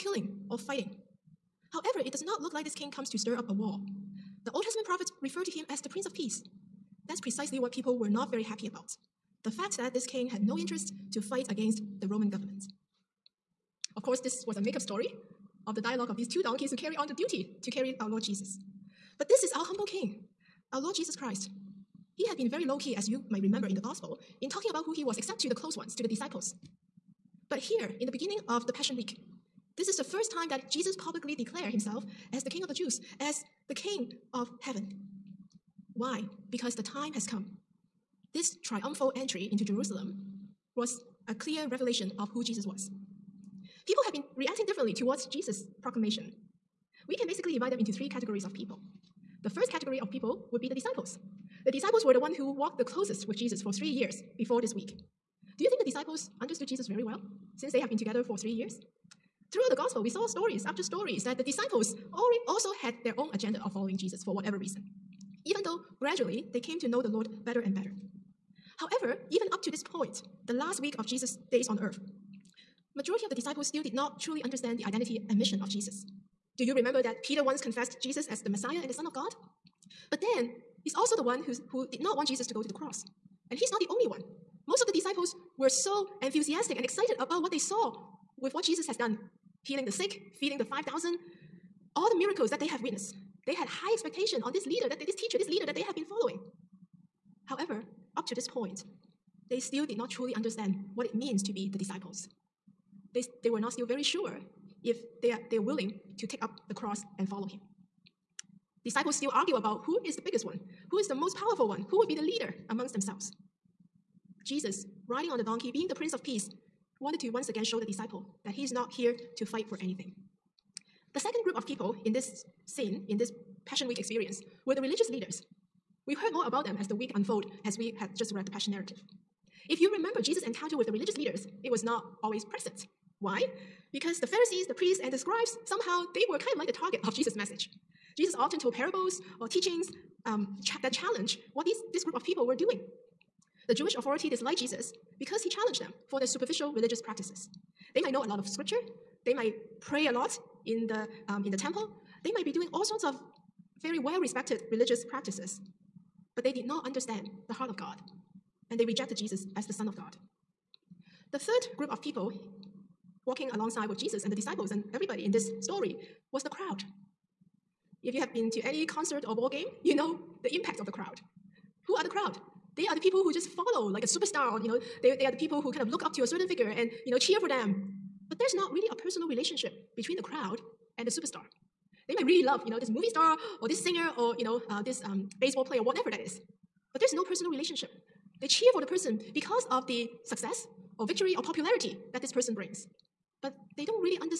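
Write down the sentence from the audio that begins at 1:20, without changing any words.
But then, he's also the one who's, who did not want Jesus to go to the cross.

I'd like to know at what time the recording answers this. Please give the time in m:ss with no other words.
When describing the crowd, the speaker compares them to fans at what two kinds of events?
2:48.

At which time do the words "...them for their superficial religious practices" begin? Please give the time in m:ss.
2:25.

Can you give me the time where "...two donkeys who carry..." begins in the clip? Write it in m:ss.
0:16.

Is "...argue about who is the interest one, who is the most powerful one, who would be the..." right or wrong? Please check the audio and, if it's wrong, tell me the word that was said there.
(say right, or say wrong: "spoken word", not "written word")
wrong: "biggest", not "interest".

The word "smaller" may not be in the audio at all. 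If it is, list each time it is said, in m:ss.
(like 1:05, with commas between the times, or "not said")
not said.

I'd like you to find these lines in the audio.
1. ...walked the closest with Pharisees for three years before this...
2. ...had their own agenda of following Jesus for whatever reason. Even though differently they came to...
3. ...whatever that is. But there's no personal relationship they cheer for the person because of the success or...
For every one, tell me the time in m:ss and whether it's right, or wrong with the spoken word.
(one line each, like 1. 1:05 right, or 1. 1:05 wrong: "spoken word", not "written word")
1. 0:52 wrong: "Jesus", not "Pharisees"
2. 1:02 wrong: "gradually", not "differently"
3. 3:05 right.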